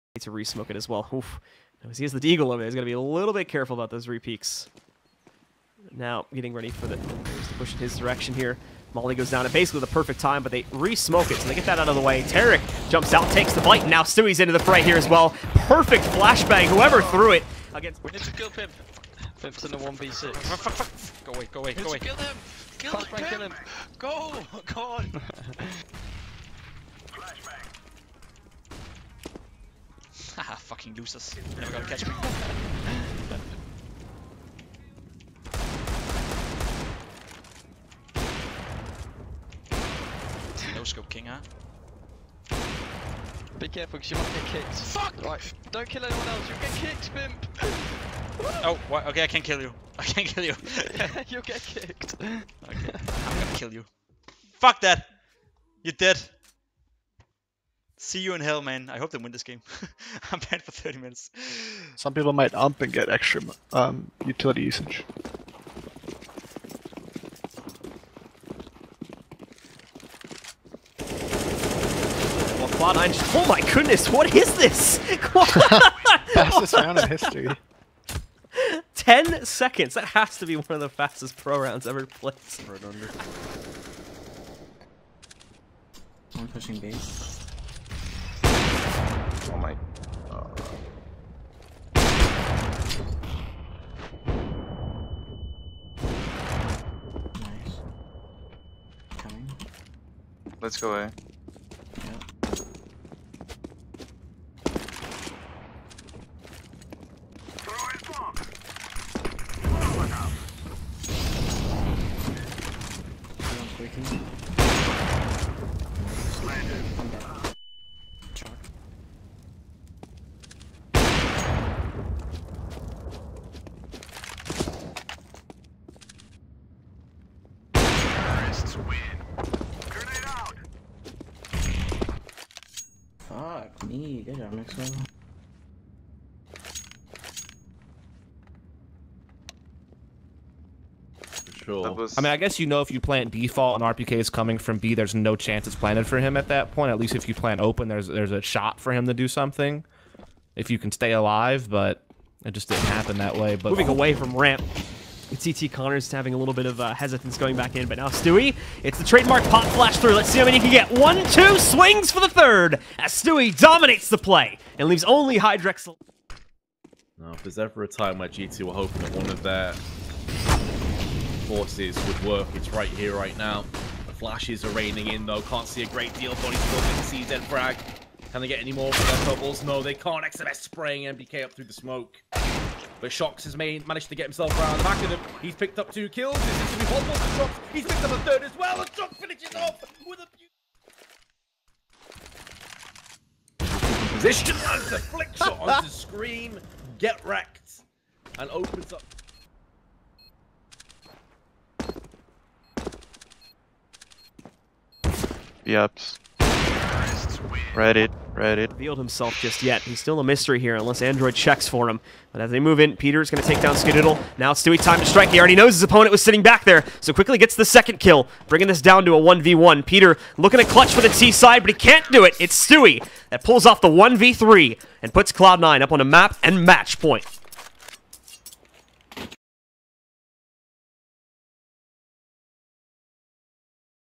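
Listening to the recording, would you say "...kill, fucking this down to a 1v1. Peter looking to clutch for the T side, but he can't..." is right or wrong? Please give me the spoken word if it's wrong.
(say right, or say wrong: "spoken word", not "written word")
wrong: "bringing", not "fucking".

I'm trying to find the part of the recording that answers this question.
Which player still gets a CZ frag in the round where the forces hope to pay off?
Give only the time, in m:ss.
2:56.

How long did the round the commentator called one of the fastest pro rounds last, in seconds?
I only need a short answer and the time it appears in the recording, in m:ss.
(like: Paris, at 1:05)
10, at 1:18.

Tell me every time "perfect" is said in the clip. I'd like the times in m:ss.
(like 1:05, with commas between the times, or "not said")
0:09, 0:15.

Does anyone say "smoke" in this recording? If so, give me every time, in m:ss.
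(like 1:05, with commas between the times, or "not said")
0:00, 0:10, 3:01.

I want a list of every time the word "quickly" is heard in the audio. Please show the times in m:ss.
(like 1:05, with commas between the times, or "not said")
3:37.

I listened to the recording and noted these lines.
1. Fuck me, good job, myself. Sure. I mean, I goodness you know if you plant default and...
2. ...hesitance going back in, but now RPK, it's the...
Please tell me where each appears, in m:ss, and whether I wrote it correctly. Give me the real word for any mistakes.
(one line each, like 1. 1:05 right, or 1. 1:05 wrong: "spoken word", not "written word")
1. 2:13 wrong: "guess", not "goodness"
2. 2:36 wrong: "Stewie", not "RPK".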